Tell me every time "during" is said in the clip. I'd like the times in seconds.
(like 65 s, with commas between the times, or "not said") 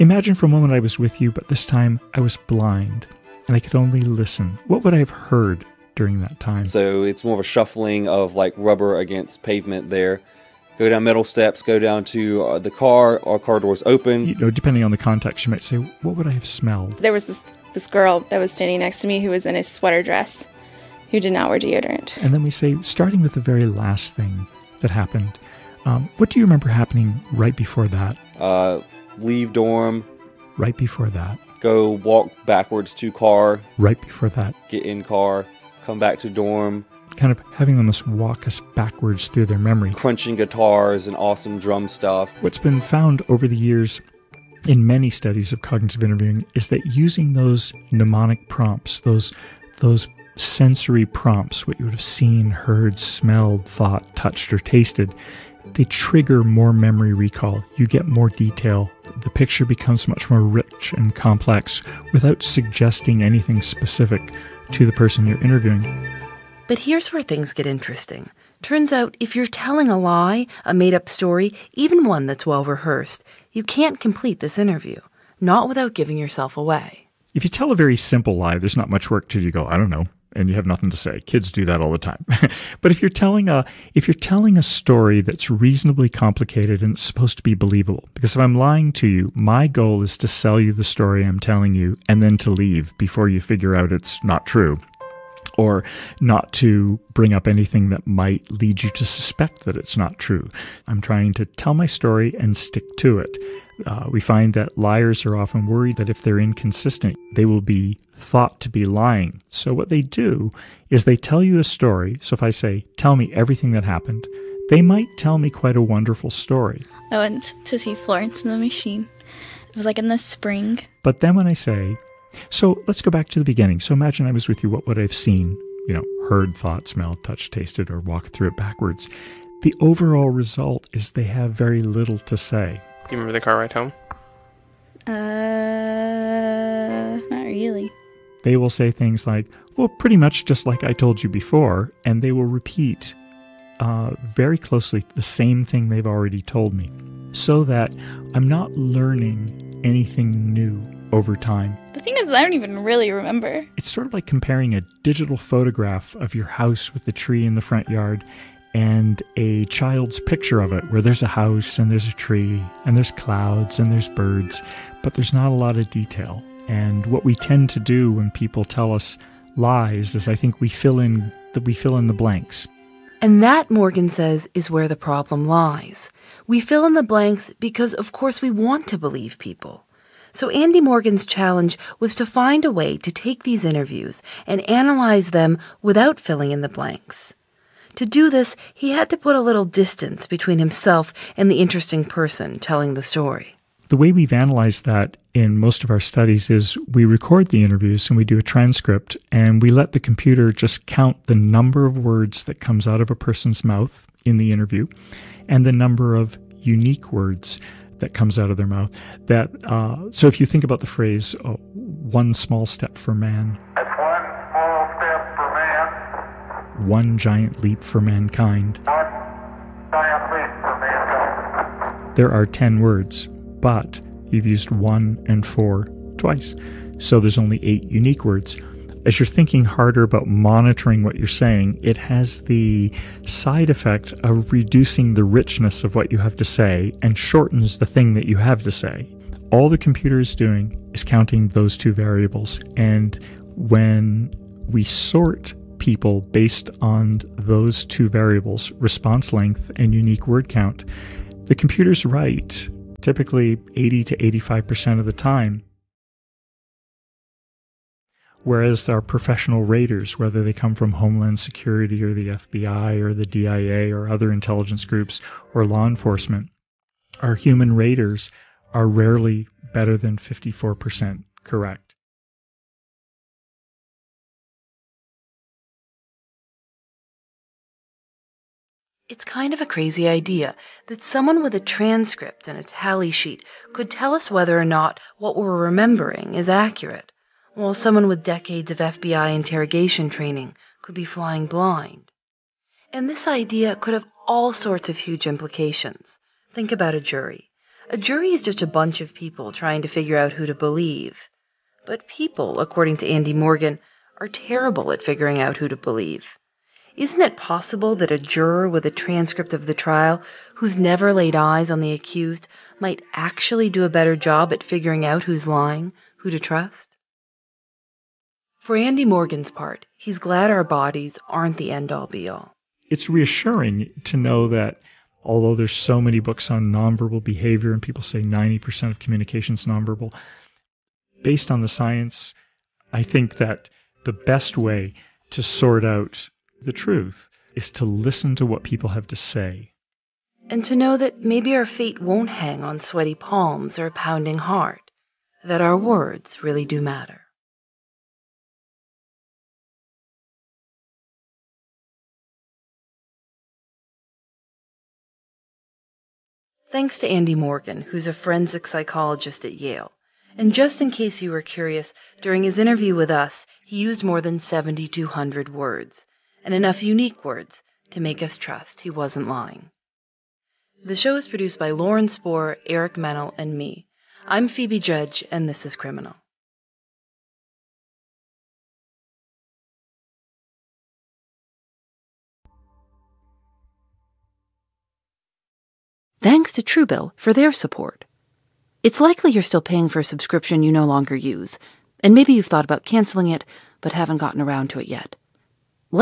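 5 s, 362 s.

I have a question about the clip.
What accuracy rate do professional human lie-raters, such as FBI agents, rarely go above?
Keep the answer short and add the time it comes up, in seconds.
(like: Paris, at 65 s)
54%, at 270 s.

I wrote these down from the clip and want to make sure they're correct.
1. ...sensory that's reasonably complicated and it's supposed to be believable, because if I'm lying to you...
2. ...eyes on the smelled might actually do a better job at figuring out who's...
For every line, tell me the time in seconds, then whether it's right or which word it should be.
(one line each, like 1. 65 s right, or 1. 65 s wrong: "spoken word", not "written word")
1. 84 s wrong: "story", not "sensory"
2. 311 s wrong: "accused", not "smelled".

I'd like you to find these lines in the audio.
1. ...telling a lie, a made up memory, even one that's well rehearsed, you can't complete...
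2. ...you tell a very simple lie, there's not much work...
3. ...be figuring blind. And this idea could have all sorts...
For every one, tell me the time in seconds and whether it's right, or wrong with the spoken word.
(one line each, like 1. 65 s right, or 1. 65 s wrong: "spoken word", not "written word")
1. 69 s wrong: "story", not "memory"
2. 77 s right
3. 290 s wrong: "flying", not "figuring".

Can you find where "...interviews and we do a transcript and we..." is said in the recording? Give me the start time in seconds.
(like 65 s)
197 s.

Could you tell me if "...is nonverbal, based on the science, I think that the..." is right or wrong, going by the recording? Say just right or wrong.
right.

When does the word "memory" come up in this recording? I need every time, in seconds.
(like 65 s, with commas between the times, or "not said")
39 s, 56 s.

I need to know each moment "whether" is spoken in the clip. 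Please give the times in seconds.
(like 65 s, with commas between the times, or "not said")
260 s, 284 s.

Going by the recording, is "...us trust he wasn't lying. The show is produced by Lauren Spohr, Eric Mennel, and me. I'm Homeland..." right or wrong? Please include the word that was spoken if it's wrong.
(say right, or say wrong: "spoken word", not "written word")
wrong: "Phoebe", not "Homeland".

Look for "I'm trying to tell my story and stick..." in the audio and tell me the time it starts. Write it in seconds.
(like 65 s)
100 s.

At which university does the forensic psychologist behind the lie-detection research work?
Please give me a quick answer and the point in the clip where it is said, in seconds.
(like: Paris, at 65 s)
Yale, at 359 s.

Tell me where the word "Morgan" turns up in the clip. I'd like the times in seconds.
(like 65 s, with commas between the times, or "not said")
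173 s, 180 s, 303 s, 319 s, 357 s.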